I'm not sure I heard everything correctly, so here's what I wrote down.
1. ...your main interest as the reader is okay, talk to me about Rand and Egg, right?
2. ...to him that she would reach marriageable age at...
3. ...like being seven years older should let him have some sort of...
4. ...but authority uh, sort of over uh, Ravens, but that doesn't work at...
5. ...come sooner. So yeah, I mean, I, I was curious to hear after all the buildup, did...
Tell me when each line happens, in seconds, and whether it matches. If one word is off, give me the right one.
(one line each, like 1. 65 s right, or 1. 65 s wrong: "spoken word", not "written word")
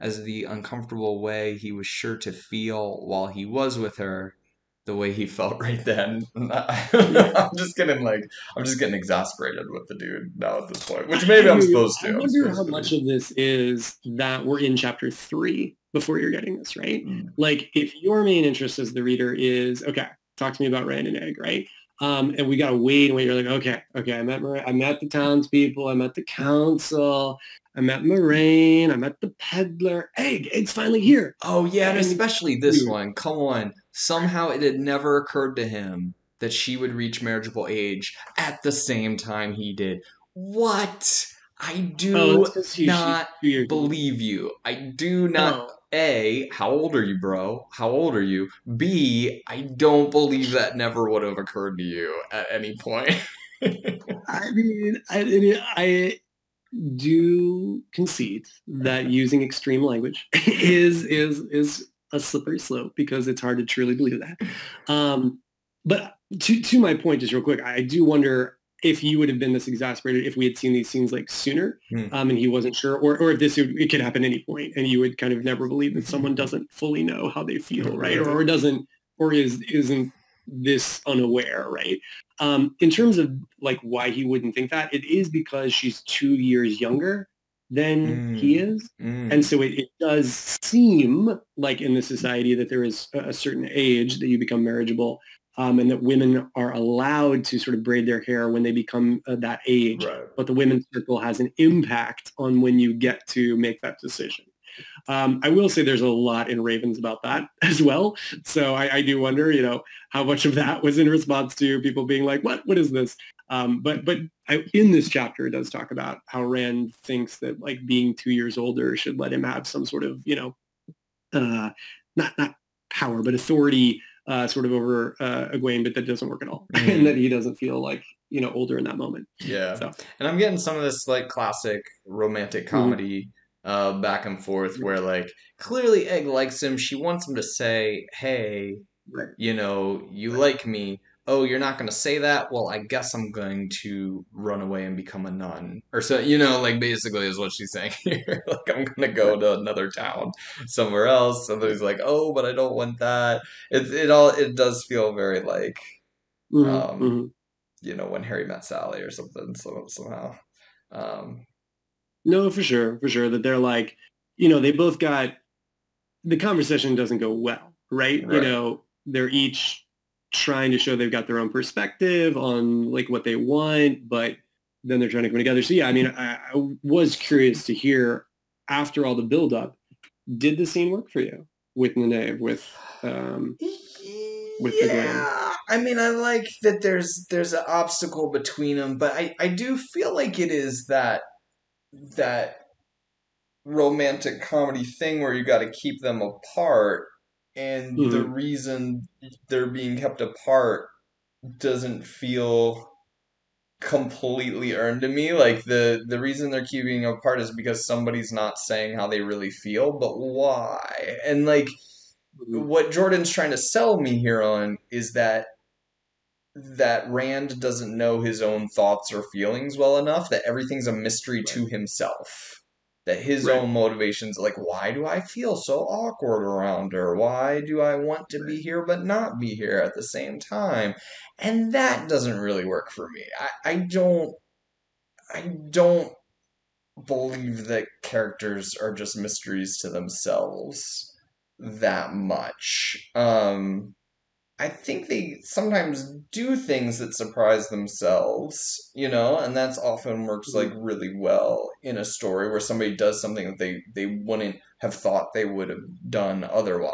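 1. 18 s right
2. 35 s right
3. 117 s wrong: "two", not "seven"
4. 123 s wrong: "Egwene", not "Ravens"
5. 175 s wrong: "together", not "sooner".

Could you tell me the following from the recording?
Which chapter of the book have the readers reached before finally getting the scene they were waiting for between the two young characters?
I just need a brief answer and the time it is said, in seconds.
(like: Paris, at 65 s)
Chapter 3, at 14 s.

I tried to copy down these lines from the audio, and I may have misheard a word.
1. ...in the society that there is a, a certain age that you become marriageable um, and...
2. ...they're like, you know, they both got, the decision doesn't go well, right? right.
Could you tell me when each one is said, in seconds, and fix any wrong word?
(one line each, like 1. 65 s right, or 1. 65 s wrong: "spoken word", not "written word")
1. 91 s right
2. 163 s wrong: "conversation", not "decision".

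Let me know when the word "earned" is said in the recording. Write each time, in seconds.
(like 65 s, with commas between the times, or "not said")
204 s.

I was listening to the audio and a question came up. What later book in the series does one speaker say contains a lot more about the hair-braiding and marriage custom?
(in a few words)
Ravens.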